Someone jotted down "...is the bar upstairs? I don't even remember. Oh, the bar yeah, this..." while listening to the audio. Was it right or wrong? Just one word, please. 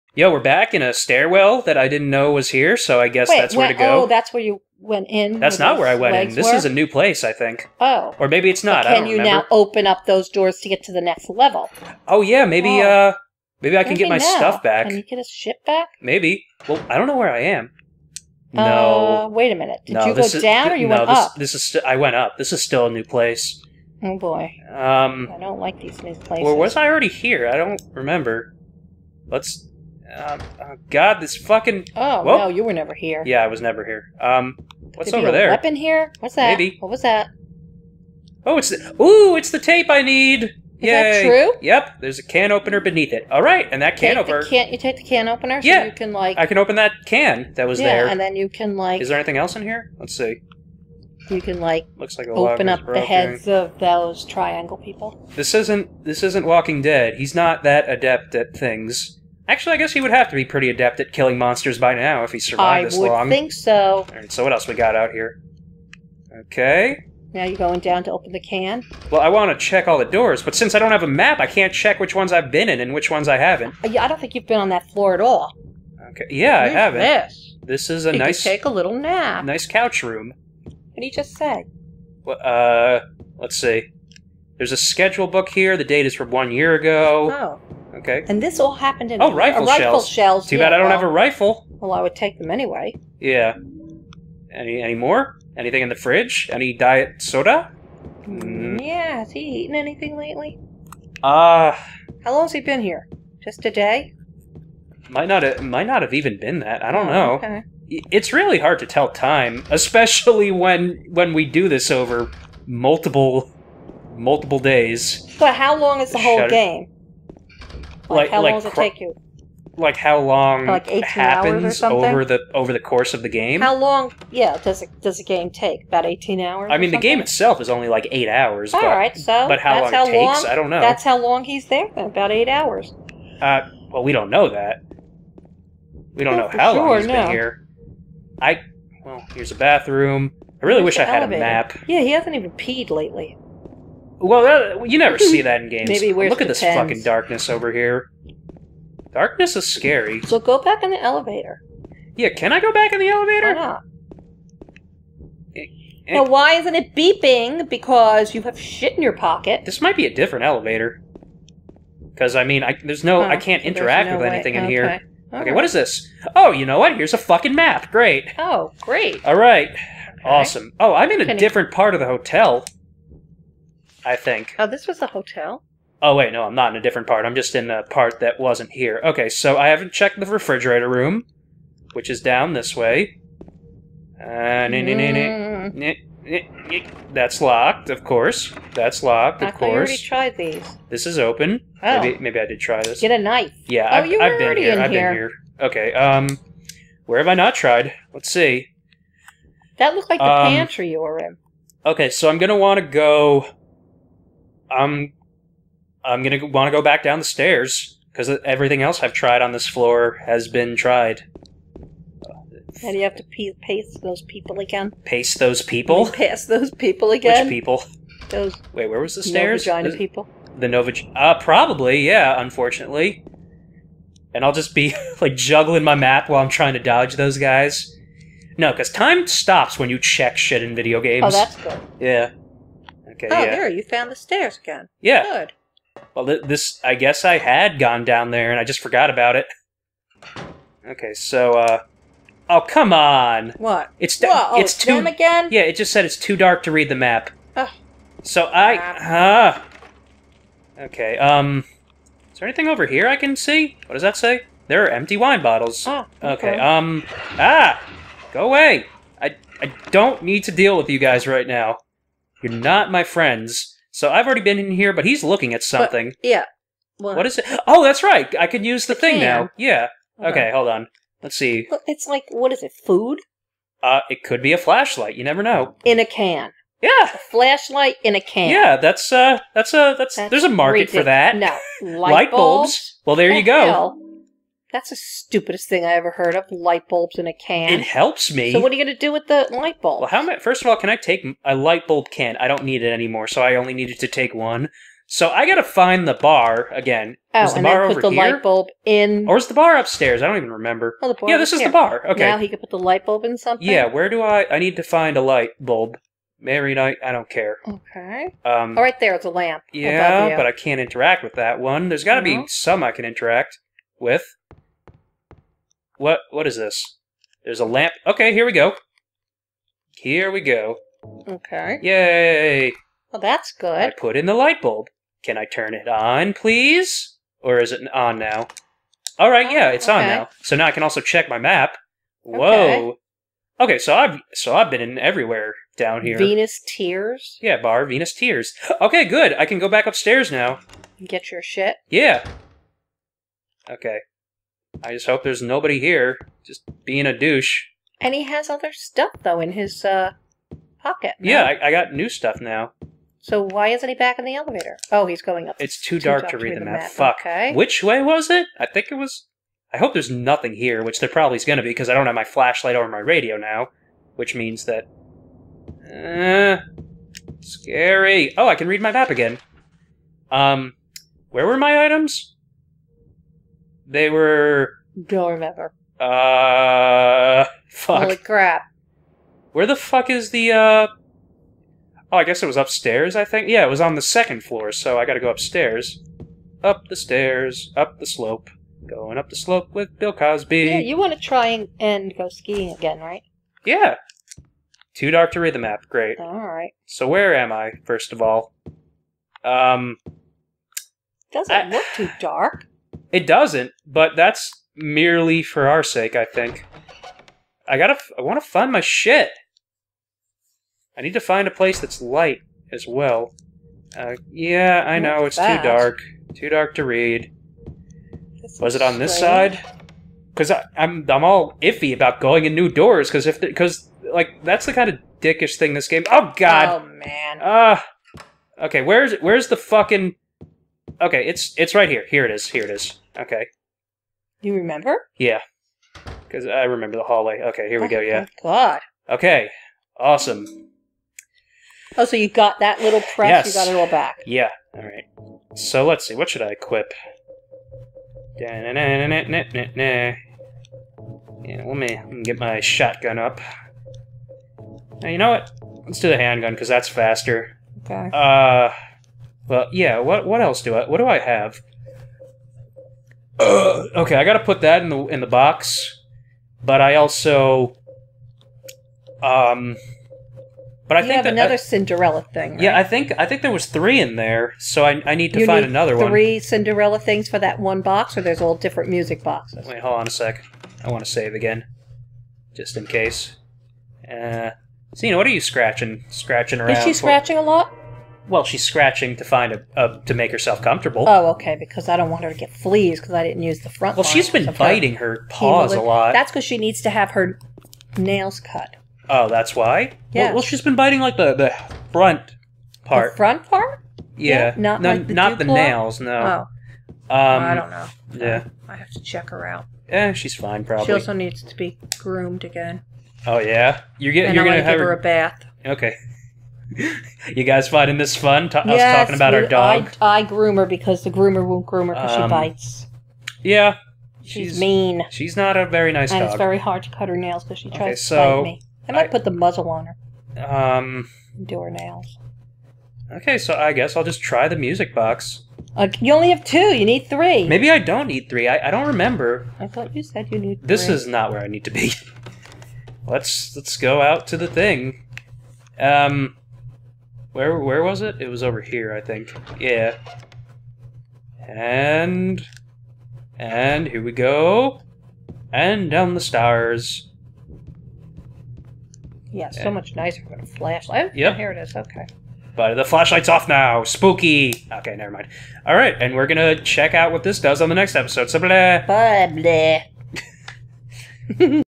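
right.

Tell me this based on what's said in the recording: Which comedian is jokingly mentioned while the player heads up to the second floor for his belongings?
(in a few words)
Bill Cosby.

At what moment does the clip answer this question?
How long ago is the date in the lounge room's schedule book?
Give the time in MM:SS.
01:26.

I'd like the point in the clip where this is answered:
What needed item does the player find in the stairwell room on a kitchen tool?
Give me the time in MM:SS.
00:39.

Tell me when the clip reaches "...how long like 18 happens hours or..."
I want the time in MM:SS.
01:59.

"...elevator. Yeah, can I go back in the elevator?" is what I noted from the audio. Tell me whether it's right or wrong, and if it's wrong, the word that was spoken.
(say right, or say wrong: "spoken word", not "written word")
right.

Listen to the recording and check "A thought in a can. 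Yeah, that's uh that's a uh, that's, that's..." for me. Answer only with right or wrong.
wrong.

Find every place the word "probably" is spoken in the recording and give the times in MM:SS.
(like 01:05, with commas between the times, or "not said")
03:41, 06:01, 08:30.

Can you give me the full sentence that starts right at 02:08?
All but, right, so but how long how it takes?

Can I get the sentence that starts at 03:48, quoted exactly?
No, because time stops when you check shit in video games.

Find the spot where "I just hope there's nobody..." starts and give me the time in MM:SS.
05:44.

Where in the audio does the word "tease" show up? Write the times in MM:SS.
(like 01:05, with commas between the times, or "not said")
not said.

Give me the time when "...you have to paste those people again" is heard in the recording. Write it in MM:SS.
03:32.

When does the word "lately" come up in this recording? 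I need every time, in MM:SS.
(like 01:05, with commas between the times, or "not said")
01:40, 02:22.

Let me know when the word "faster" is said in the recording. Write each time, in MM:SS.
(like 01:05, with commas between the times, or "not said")
07:36.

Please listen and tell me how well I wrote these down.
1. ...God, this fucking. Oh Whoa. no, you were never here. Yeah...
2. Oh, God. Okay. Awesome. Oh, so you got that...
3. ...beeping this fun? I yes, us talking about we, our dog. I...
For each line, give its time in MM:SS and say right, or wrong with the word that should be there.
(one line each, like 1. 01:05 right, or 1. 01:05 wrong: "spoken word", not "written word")
1. 00:30 right
2. 07:18 right
3. 08:37 wrong: "finding", not "beeping".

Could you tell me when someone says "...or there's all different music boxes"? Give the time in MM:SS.
07:58.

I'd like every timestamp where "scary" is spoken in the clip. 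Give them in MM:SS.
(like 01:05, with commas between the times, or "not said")
02:29, 06:07.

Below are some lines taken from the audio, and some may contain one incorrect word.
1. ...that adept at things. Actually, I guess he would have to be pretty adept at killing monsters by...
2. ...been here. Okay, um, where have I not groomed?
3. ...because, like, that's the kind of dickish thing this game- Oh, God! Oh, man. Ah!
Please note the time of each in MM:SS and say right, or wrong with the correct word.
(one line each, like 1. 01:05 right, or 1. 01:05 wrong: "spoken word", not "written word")
1. 00:57 right
2. 03:14 wrong: "tried", not "groomed"
3. 07:03 right.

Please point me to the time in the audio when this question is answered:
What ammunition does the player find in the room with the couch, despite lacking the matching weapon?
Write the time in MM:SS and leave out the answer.
01:29.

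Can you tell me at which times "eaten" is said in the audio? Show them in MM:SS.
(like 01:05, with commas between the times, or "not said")
01:39.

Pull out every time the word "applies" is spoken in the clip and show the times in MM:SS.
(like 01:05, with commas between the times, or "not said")
not said.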